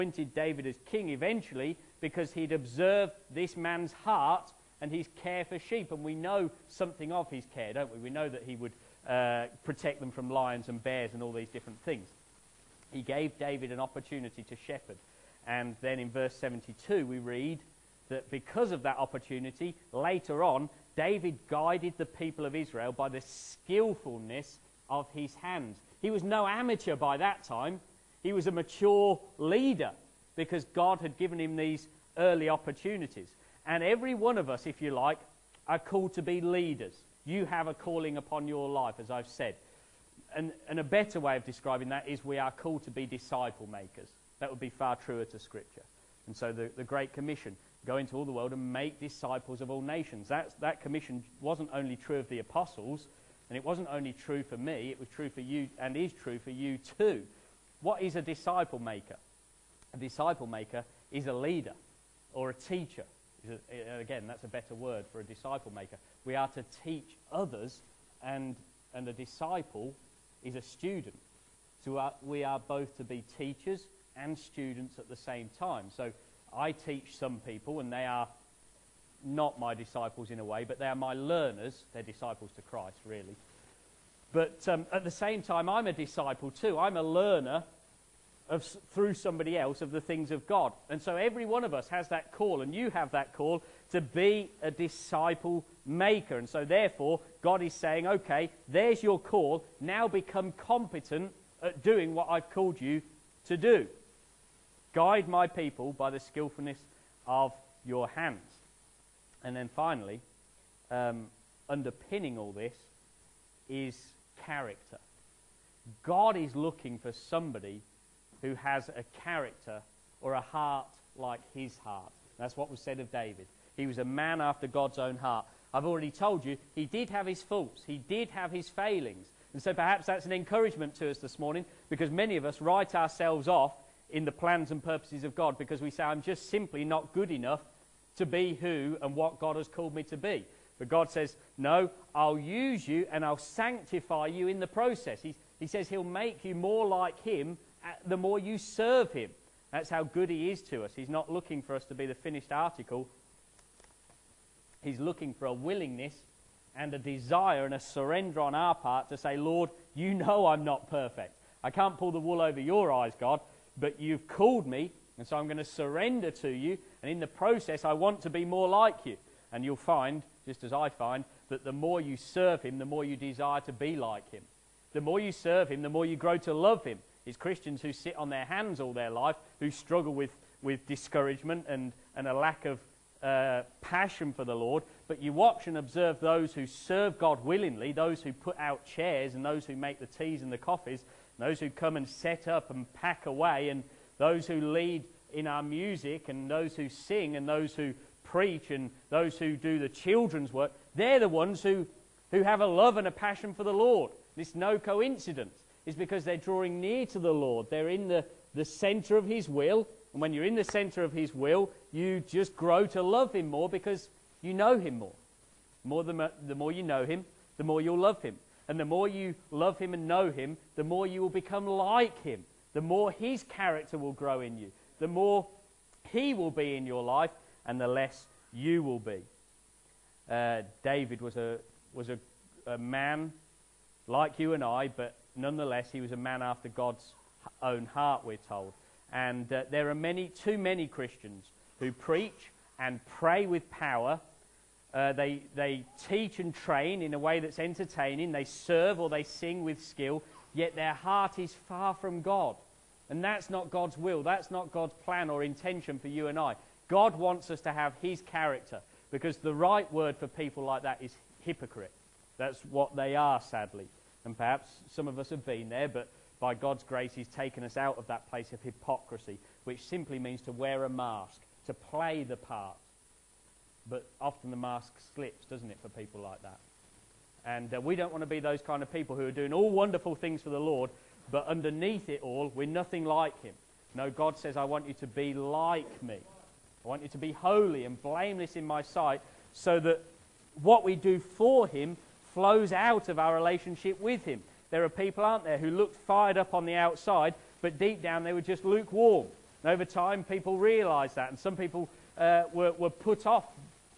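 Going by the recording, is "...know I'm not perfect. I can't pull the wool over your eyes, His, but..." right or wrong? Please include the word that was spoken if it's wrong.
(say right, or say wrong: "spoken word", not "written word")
wrong: "God", not "His".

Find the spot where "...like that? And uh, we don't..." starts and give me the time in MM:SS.
04:36.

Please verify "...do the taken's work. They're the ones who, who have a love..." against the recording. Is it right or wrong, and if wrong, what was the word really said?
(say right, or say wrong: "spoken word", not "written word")
wrong: "children", not "taken".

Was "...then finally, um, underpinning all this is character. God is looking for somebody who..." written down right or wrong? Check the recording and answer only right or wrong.
right.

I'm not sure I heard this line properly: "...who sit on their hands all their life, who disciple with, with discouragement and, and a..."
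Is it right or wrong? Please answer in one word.
wrong.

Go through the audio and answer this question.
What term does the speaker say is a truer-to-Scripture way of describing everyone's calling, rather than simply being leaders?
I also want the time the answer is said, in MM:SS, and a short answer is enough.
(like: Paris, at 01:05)
disciple makers, at 00:43.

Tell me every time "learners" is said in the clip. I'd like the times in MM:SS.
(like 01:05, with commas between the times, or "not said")
01:21, 01:27.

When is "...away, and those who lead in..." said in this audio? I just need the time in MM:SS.
03:13.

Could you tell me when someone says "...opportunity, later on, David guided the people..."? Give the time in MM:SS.
00:18.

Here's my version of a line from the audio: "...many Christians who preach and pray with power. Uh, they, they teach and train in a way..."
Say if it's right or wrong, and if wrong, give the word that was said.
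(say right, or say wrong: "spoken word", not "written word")
right.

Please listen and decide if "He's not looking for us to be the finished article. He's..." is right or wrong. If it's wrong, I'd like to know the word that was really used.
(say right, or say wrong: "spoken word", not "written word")
right.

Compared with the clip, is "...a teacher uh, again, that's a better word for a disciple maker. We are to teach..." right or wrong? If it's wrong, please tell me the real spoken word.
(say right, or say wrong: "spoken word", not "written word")
right.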